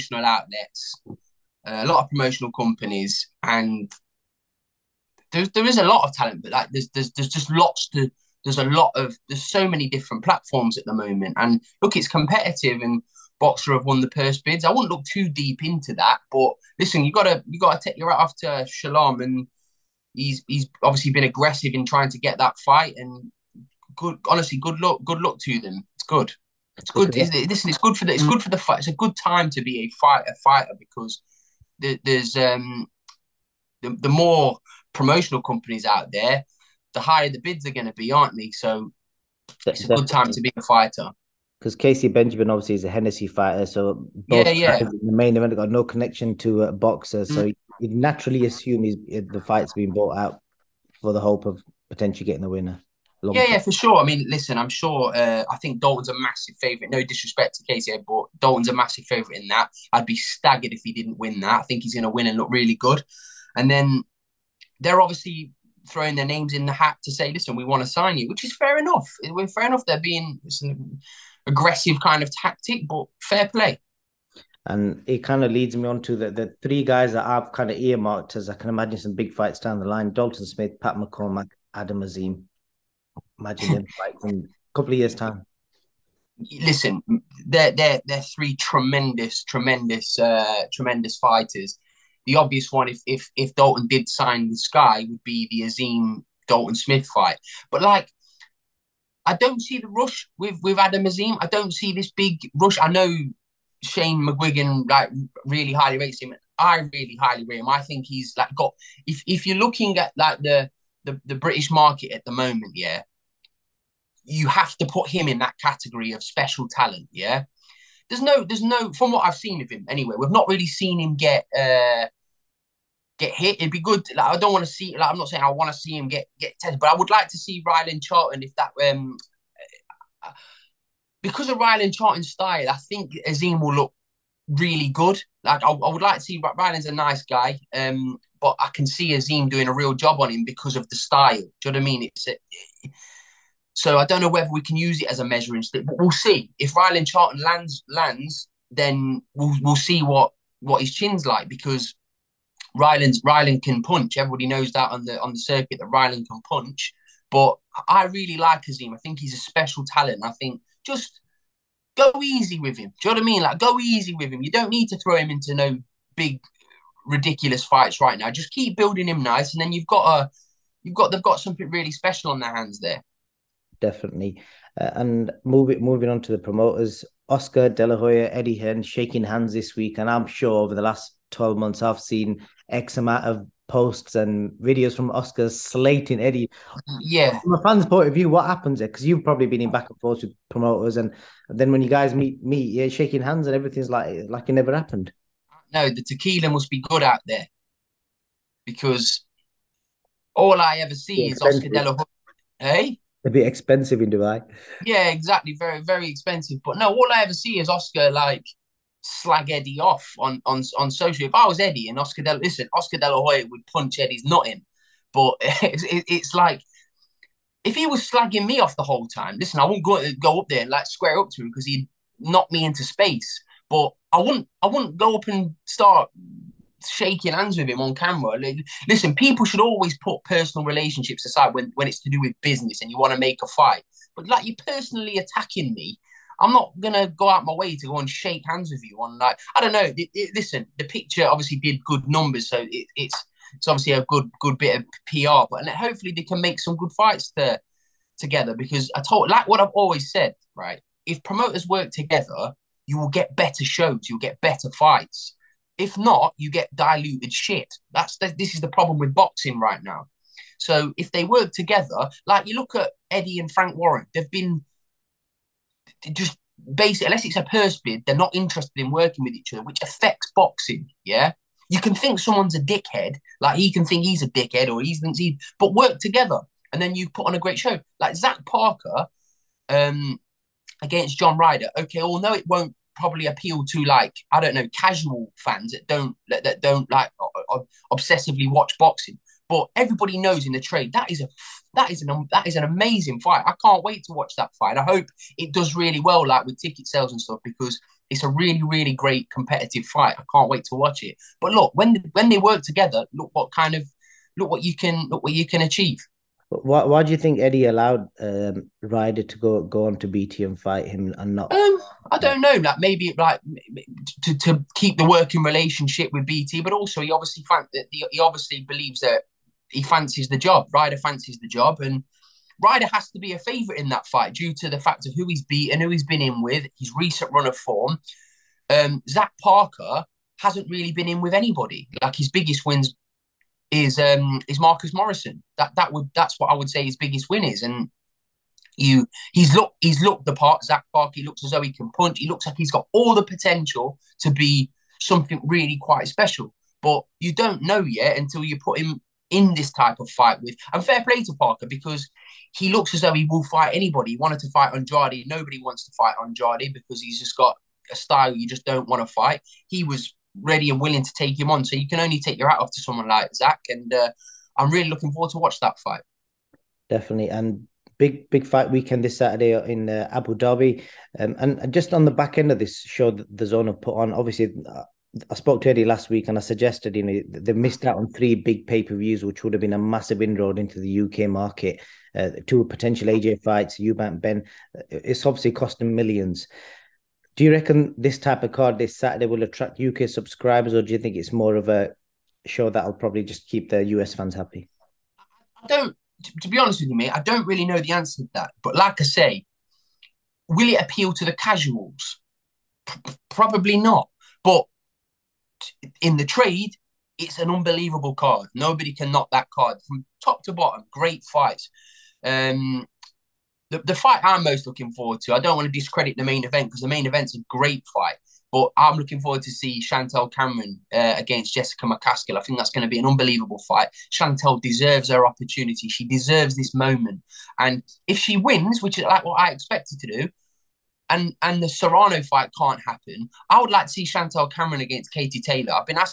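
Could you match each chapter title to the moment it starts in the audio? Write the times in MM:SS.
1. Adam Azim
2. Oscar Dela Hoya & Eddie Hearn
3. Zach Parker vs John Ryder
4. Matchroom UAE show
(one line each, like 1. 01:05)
1. 01:35
2. 02:53
3. 04:23
4. 06:06.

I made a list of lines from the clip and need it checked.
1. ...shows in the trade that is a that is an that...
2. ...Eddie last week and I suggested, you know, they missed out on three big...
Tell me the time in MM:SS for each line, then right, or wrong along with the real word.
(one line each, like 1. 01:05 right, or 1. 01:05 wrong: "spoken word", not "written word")
1. 04:50 wrong: "knows", not "shows"
2. 06:15 right.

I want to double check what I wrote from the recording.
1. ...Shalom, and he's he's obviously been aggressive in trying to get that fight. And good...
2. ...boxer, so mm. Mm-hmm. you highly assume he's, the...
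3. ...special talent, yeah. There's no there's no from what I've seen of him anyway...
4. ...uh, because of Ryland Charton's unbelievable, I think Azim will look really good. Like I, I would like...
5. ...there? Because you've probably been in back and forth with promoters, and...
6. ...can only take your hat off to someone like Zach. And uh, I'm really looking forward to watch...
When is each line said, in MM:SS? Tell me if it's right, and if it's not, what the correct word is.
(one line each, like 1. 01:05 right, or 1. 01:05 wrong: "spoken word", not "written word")
1. 00:18 right
2. 00:46 wrong: "naturally", not "highly"
3. 01:56 right
4. 02:10 wrong: "style", not "unbelievable"
5. 03:08 right
6. 06:01 right.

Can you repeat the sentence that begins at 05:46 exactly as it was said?
But you don't know yet until you put him in this type of fight with.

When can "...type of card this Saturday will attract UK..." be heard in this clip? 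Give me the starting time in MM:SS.
06:28.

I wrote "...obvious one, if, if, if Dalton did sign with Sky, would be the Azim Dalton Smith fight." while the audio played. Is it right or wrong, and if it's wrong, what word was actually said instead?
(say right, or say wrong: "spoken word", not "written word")
right.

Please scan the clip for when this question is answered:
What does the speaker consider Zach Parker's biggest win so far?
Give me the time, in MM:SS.
05:34.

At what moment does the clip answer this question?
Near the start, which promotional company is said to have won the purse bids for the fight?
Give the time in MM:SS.
00:13.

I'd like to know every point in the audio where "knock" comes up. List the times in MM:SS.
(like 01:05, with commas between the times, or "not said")
03:42, 06:49.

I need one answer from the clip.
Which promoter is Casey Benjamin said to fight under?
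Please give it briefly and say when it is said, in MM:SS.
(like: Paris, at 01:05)
Hennessy, at 00:42.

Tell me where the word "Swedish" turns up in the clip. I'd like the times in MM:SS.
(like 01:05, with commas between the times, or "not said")
not said.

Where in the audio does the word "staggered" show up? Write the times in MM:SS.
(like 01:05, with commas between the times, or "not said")
01:00.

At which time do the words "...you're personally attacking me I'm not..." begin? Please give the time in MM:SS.
03:54.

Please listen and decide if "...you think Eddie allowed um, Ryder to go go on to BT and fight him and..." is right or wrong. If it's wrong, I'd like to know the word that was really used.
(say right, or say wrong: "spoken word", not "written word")
right.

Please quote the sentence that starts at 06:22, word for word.
Uh, two potential AJ fights, Eubank Benn.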